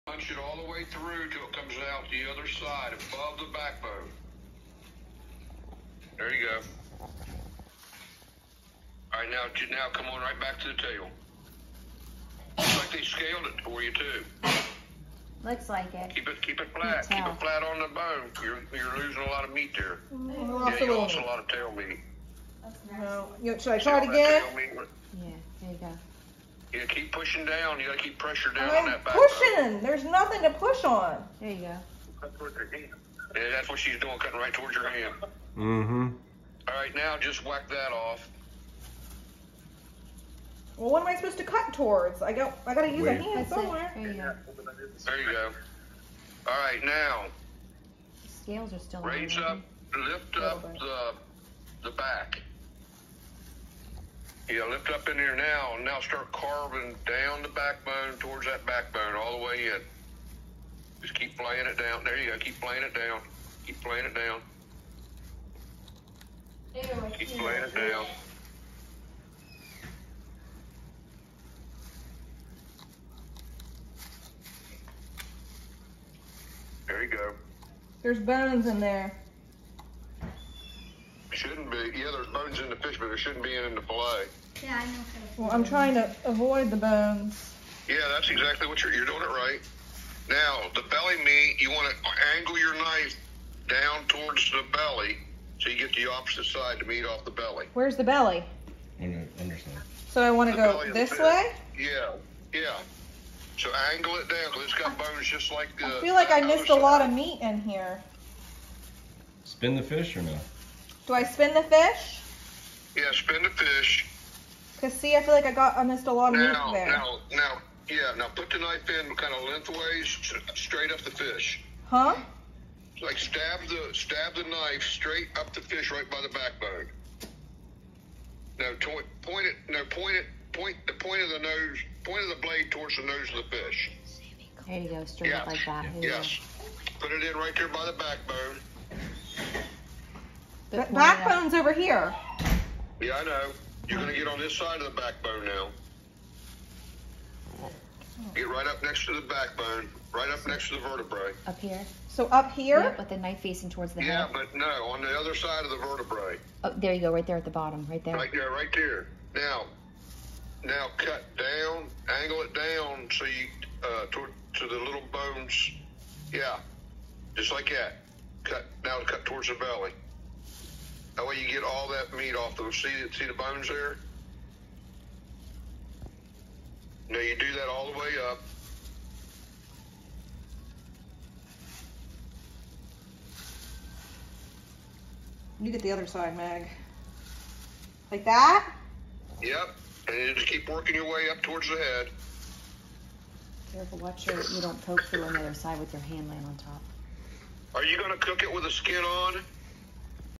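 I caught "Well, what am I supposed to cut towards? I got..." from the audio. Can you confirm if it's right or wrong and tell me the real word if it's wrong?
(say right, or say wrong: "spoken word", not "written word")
right.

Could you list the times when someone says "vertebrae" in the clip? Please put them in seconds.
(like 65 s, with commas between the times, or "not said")
150 s, 155 s.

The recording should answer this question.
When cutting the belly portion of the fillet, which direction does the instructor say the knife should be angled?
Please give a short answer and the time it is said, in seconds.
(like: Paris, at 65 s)
Down towards the belly, at 93 s.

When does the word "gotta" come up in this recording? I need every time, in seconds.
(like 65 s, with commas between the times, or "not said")
27 s, 42 s.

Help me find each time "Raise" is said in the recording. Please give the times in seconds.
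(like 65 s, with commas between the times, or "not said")
49 s.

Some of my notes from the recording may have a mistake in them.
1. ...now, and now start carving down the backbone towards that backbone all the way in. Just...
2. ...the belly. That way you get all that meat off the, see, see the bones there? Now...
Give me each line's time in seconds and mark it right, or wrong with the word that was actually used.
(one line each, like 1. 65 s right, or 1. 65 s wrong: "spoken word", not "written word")
1. 55 s right
2. 169 s right.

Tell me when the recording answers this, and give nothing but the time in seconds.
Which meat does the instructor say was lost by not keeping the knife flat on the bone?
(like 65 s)
21 s.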